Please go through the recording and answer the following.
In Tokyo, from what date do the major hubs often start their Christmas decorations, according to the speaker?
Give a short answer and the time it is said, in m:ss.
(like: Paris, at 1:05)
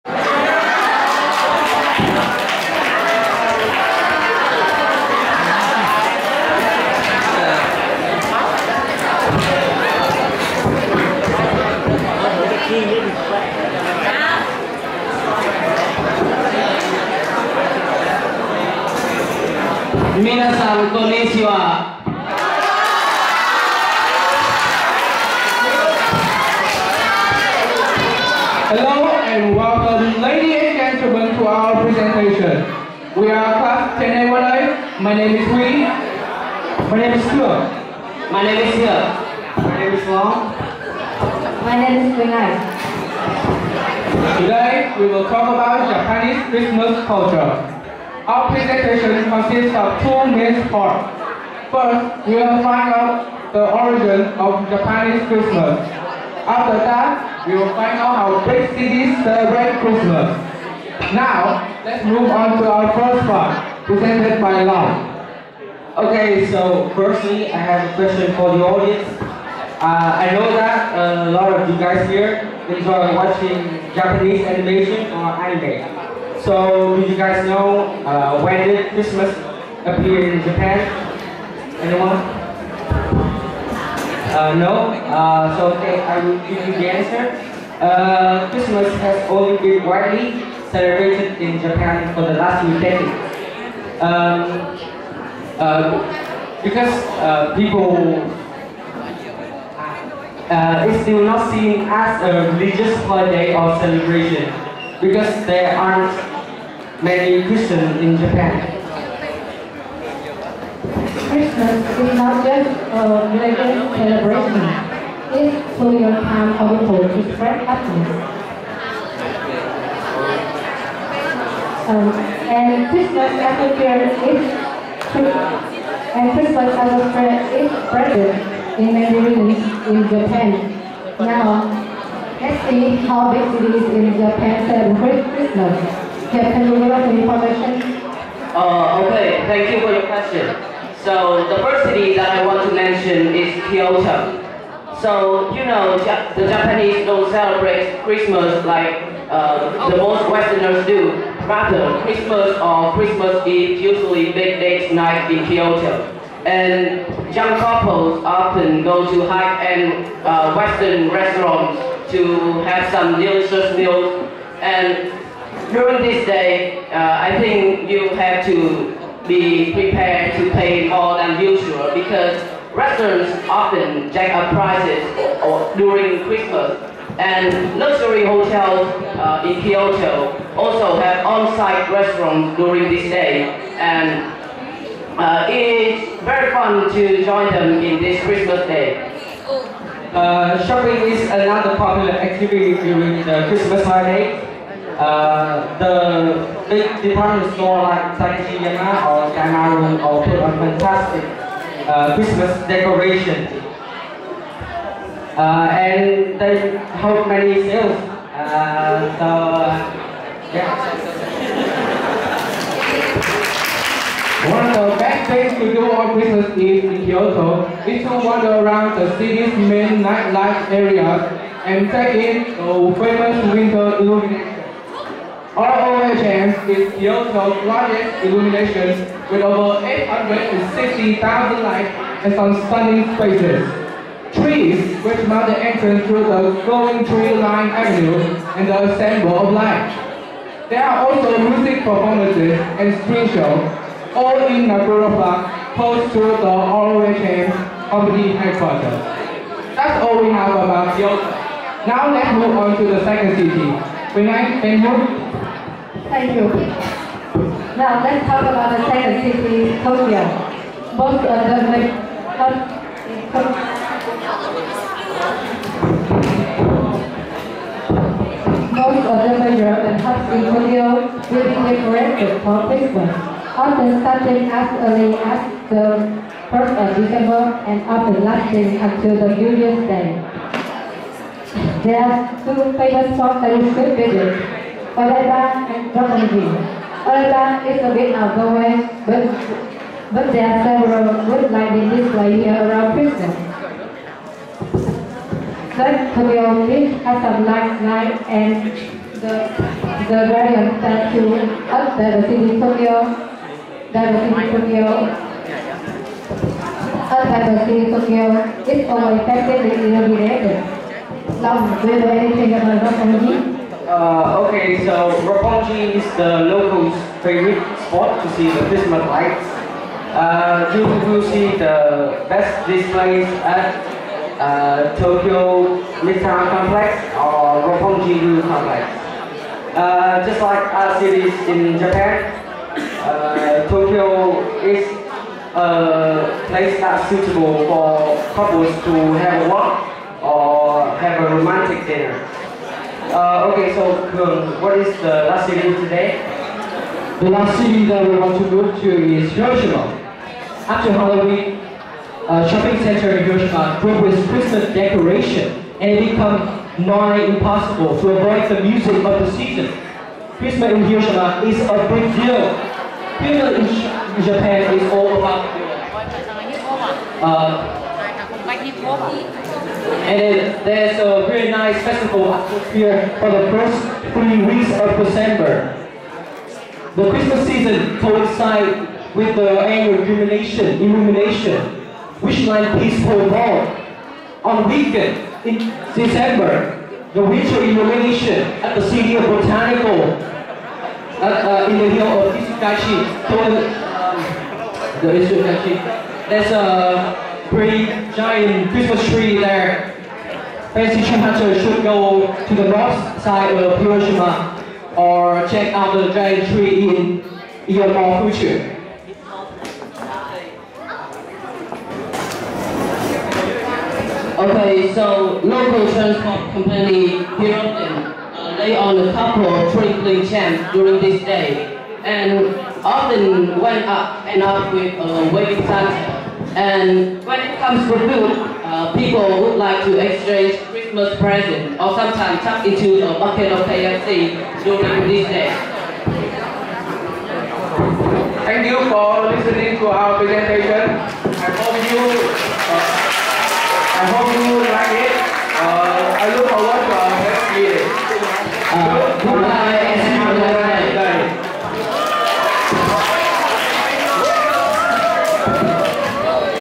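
1st of December, at 4:36.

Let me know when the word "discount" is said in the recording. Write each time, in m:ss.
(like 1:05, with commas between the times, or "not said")
not said.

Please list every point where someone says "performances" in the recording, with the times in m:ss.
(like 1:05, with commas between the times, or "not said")
4:01.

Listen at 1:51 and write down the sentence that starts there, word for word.
Christmas is not just a religious celebration.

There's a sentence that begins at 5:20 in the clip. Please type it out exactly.
Uh, you will see the best displays at uh, Tokyo Midtown Complex or Roppongi Ryu Complex.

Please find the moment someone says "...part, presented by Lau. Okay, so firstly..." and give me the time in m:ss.
1:03.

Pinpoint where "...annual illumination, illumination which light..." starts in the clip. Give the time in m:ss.
6:19.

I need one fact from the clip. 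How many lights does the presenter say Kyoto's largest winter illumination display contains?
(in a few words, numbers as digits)
860,000.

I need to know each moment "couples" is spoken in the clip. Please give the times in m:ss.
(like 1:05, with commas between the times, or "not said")
2:37, 5:38, 6:59.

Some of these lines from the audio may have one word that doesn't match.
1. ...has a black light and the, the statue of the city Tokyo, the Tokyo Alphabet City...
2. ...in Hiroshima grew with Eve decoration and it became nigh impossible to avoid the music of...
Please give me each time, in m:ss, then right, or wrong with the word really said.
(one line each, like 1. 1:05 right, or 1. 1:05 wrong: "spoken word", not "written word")
1. 4:57 right
2. 5:53 wrong: "Christmas", not "Eve".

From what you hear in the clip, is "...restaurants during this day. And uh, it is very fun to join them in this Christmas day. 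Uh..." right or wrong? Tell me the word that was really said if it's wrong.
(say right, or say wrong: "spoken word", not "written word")
right.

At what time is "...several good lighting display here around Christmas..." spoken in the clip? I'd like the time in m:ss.
4:50.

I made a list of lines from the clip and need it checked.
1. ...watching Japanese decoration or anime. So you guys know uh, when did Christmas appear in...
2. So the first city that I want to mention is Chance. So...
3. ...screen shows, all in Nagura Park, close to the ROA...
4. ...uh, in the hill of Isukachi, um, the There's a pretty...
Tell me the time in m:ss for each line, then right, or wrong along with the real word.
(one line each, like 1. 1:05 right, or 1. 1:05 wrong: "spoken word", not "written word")
1. 1:13 wrong: "animation", not "decoration"
2. 2:21 wrong: "Kyoto", not "Chance"
3. 4:03 right
4. 6:31 right.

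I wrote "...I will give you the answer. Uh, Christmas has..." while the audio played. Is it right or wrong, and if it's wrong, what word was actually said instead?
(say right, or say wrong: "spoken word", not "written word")
right.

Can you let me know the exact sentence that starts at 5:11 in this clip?
Now, do you know anything about rock energy?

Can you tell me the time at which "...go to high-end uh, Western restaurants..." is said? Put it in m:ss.
2:38.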